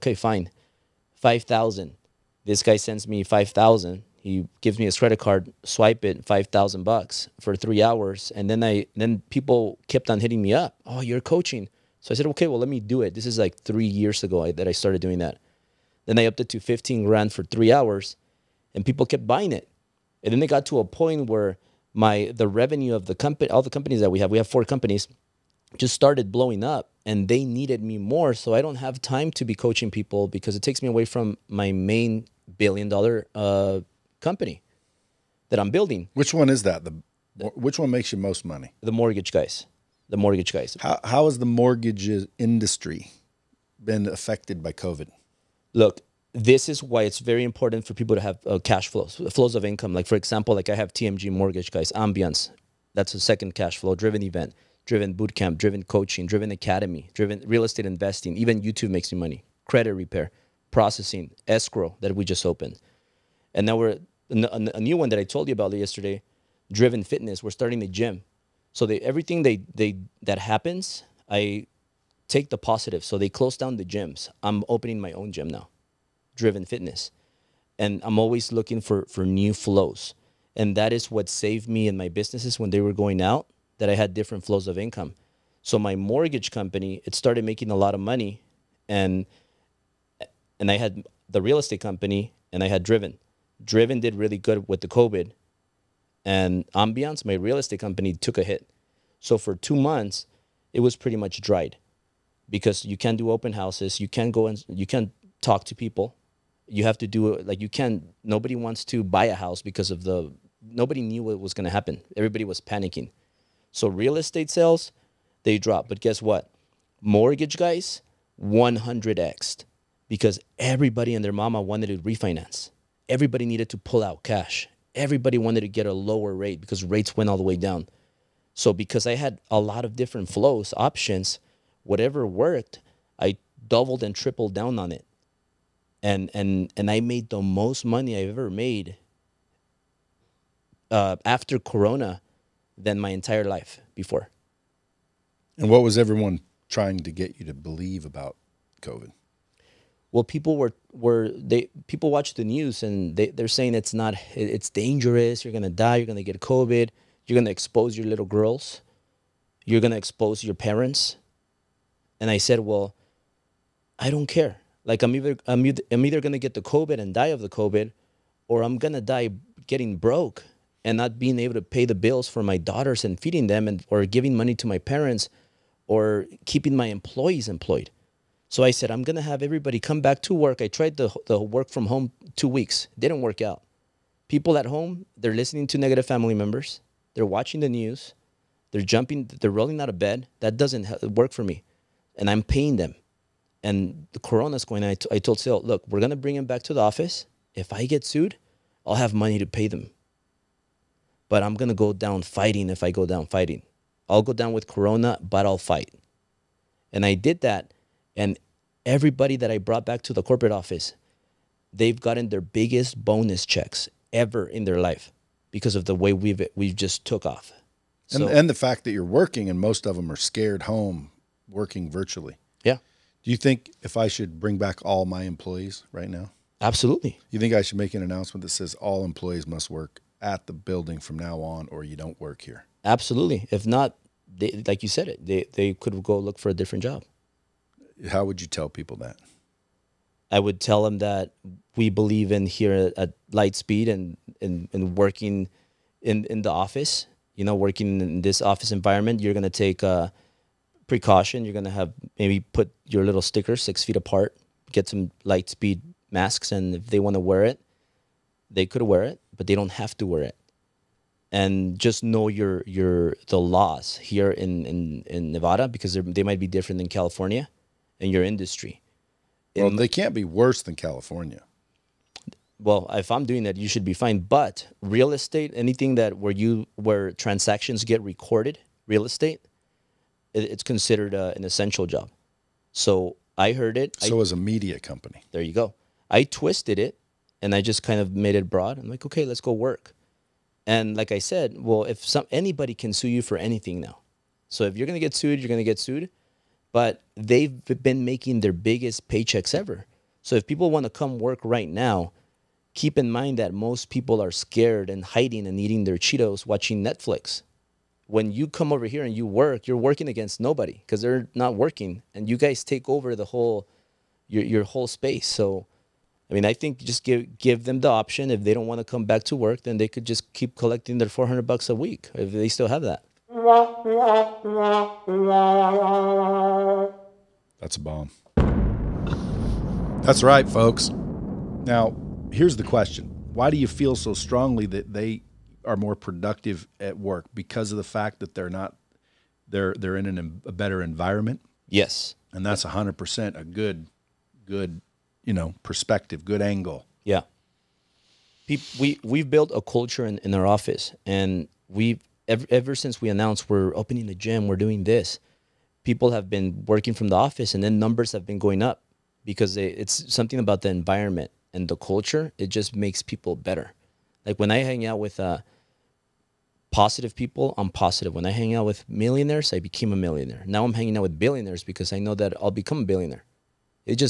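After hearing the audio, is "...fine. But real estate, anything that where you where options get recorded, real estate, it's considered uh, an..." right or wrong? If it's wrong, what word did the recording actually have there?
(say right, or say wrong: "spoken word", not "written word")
wrong: "transactions", not "options".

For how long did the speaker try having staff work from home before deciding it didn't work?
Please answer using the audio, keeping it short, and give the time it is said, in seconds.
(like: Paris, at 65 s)
2 weeks, at 182 s.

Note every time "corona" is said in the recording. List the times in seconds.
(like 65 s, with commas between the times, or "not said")
141 s, 194 s, 204 s.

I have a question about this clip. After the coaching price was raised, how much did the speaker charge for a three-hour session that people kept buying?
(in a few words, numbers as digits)
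15 grand.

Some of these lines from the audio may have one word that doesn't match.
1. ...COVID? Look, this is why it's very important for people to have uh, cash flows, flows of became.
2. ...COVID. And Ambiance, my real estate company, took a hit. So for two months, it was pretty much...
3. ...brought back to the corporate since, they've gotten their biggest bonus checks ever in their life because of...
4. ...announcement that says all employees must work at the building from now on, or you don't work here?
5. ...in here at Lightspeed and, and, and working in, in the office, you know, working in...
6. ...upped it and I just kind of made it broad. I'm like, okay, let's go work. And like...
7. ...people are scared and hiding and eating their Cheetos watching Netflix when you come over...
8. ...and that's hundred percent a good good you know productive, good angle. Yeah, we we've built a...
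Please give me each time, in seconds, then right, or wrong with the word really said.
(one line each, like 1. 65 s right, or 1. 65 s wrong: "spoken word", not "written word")
1. 44 s wrong: "income", not "became"
2. 94 s right
3. 209 s wrong: "office", not "since"
4. 228 s right
5. 242 s right
6. 286 s wrong: "twisted", not "upped"
7. 303 s right
8. 342 s wrong: "perspective", not "productive".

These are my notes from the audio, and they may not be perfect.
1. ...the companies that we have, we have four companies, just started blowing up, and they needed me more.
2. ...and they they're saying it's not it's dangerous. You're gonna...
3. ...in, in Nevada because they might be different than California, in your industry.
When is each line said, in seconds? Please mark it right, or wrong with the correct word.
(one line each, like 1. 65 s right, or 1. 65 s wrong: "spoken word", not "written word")
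1. 23 s right
2. 152 s right
3. 264 s right.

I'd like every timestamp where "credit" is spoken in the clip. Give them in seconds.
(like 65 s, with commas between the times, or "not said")
4 s, 59 s.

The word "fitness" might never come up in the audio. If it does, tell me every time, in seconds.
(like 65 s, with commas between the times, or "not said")
67 s, 76 s.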